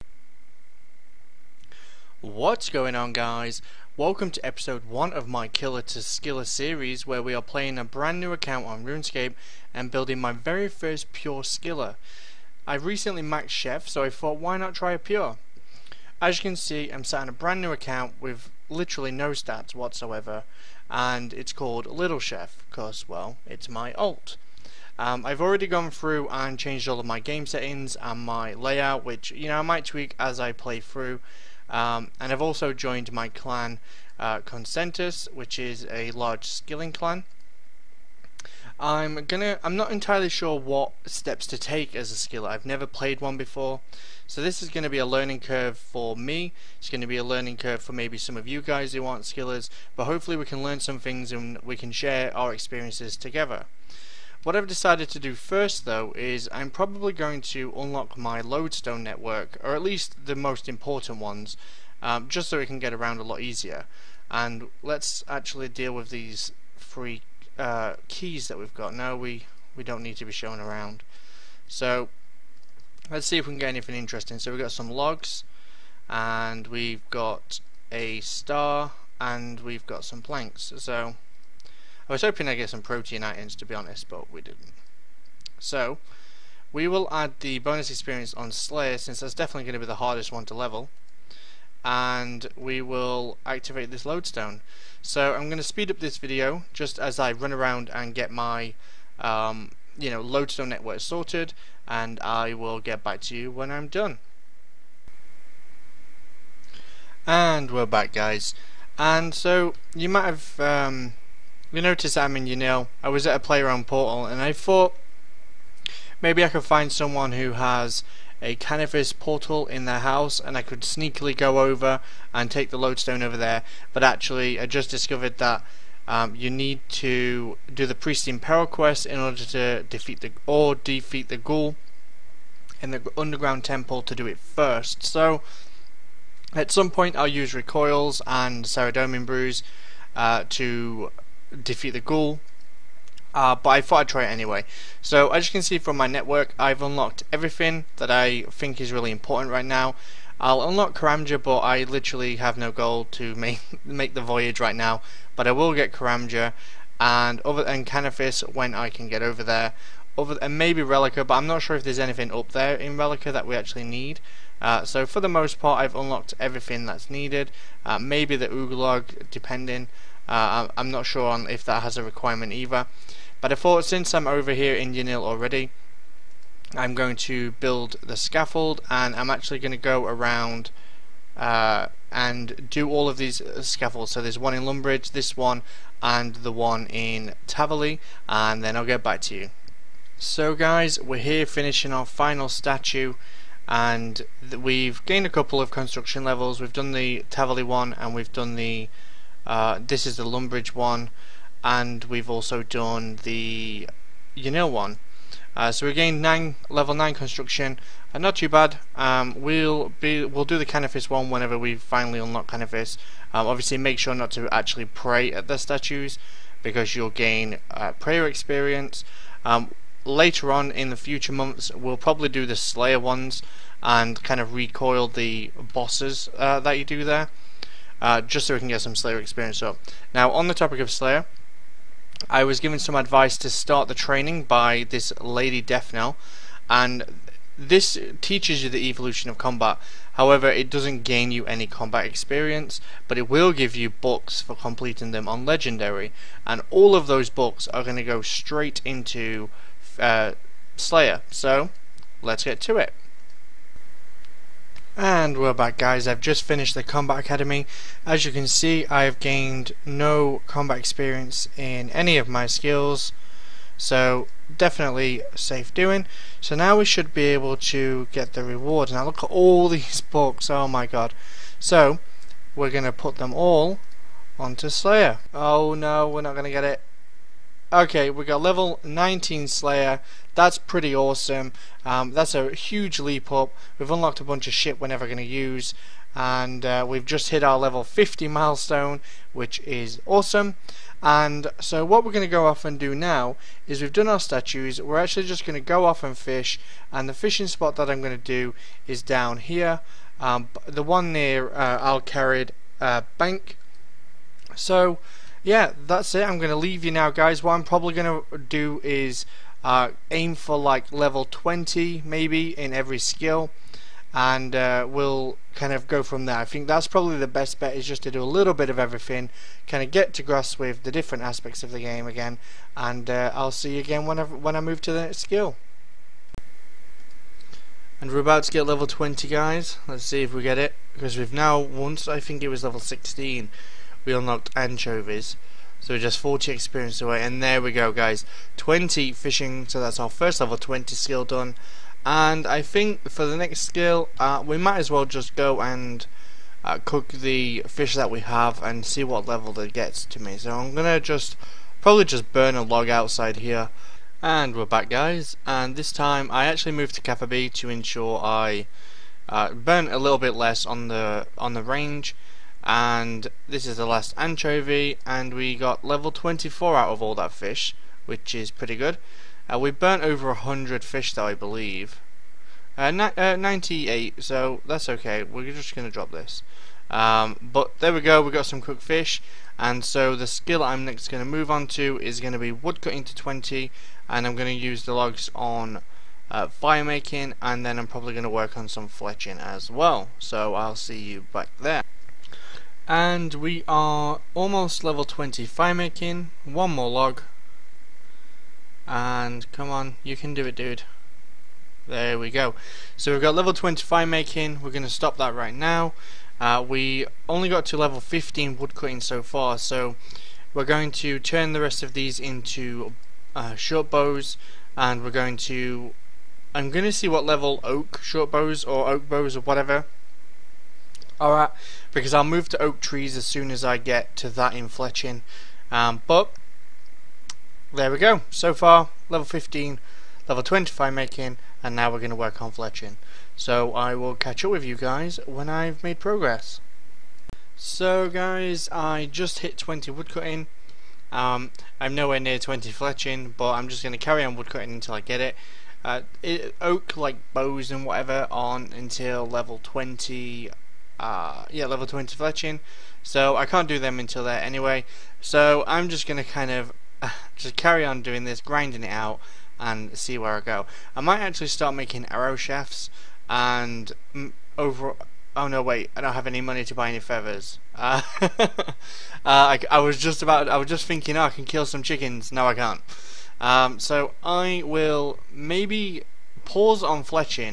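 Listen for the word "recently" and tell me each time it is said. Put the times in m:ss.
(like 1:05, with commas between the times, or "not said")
0:12.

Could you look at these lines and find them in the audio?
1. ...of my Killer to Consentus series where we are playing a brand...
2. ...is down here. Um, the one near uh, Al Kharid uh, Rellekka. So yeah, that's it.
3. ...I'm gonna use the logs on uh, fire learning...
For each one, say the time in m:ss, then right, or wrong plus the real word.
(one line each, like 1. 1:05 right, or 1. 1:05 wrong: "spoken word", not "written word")
1. 0:05 wrong: "Skiller", not "Consentus"
2. 4:58 wrong: "Bank", not "Rellekka"
3. 6:24 wrong: "making", not "learning".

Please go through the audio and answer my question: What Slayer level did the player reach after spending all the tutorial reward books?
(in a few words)
19.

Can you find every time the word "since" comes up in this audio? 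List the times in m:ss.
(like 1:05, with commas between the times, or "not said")
1:28, 2:53.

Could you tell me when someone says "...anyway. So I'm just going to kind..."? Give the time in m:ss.
7:34.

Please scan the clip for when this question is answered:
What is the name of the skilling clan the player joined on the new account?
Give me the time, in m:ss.
0:34.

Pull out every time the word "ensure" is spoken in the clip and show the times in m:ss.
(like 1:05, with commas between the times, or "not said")
5:57.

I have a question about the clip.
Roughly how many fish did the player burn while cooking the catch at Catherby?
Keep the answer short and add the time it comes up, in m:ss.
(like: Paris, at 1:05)
98, at 6:13.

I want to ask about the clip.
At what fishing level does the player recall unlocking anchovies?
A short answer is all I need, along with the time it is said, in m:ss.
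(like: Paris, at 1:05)
16, at 5:32.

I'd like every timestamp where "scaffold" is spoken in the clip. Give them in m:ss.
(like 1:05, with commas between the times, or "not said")
2:58, 3:03.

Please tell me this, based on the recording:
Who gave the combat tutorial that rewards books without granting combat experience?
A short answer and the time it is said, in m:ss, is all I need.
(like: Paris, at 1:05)
Lady Deathnell, at 3:55.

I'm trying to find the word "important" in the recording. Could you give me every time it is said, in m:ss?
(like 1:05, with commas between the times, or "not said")
1:00, 2:29.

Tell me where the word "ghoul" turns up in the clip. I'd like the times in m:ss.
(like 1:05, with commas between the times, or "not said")
2:11, 2:22.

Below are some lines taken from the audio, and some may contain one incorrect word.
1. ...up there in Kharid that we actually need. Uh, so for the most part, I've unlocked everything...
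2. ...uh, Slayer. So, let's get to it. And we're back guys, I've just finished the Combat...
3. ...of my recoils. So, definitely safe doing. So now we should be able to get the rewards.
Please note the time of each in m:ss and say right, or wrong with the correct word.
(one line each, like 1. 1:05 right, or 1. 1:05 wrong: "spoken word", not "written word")
1. 2:42 wrong: "Rellekka", not "Kharid"
2. 4:09 right
3. 4:22 wrong: "skills", not "recoils".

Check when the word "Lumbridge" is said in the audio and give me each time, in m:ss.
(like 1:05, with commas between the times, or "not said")
3:04, 3:20.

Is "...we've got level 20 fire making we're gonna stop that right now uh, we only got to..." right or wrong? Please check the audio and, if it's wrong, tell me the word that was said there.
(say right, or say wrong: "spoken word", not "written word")
right.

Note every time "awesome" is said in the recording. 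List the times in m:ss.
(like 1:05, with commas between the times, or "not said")
4:40, 4:50.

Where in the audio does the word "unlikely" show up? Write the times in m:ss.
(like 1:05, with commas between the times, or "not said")
not said.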